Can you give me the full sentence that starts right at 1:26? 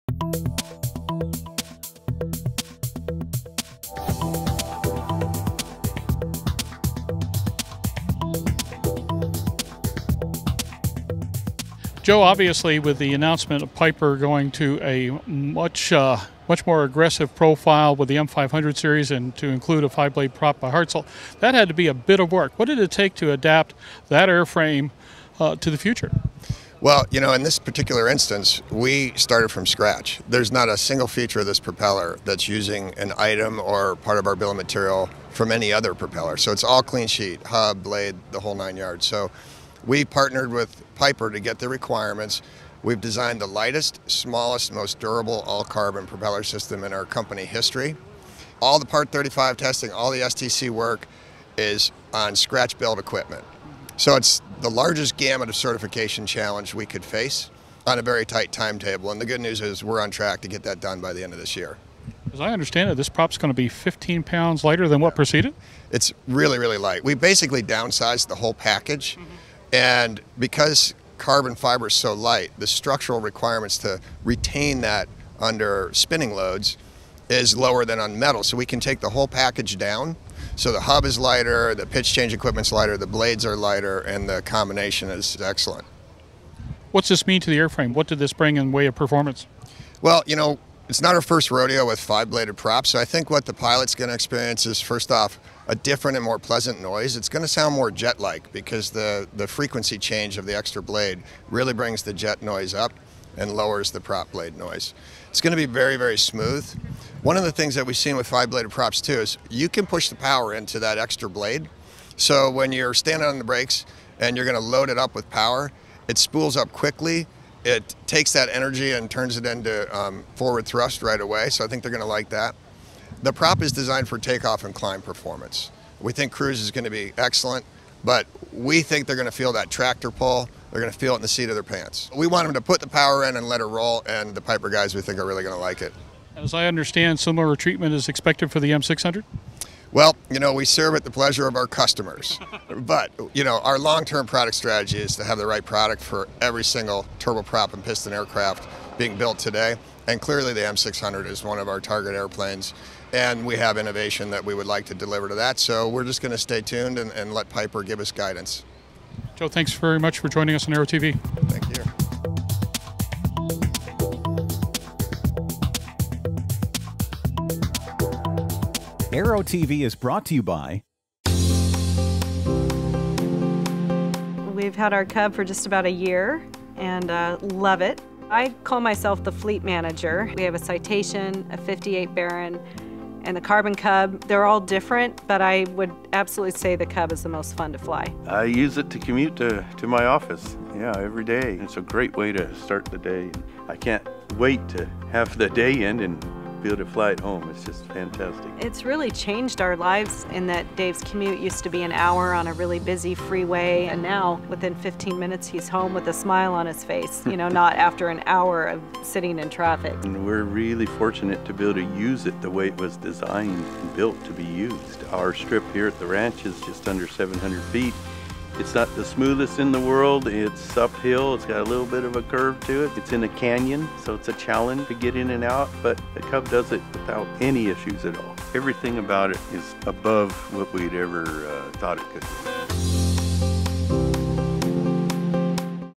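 What's this mean to the airframe?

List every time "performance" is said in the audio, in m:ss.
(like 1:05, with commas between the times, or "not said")
1:28, 2:05.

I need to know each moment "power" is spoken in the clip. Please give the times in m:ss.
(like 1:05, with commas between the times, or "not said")
1:50, 1:55, 2:12.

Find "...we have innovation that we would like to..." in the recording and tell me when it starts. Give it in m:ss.
2:33.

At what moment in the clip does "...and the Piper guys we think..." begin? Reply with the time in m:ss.
2:14.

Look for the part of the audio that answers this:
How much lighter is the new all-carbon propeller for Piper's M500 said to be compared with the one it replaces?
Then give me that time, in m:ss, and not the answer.
1:03.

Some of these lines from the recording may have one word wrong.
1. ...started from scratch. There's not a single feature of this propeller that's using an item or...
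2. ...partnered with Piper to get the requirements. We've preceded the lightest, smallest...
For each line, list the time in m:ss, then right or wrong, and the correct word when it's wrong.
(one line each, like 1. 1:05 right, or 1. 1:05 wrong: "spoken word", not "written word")
1. 0:29 right
2. 0:40 wrong: "designed", not "preceded".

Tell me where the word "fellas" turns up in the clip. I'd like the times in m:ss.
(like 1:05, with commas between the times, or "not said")
not said.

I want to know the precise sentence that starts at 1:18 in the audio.
So we can take the whole package down.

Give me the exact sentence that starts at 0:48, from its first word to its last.
All the Part 35 testing, all the STC work is on scratch-built equipment.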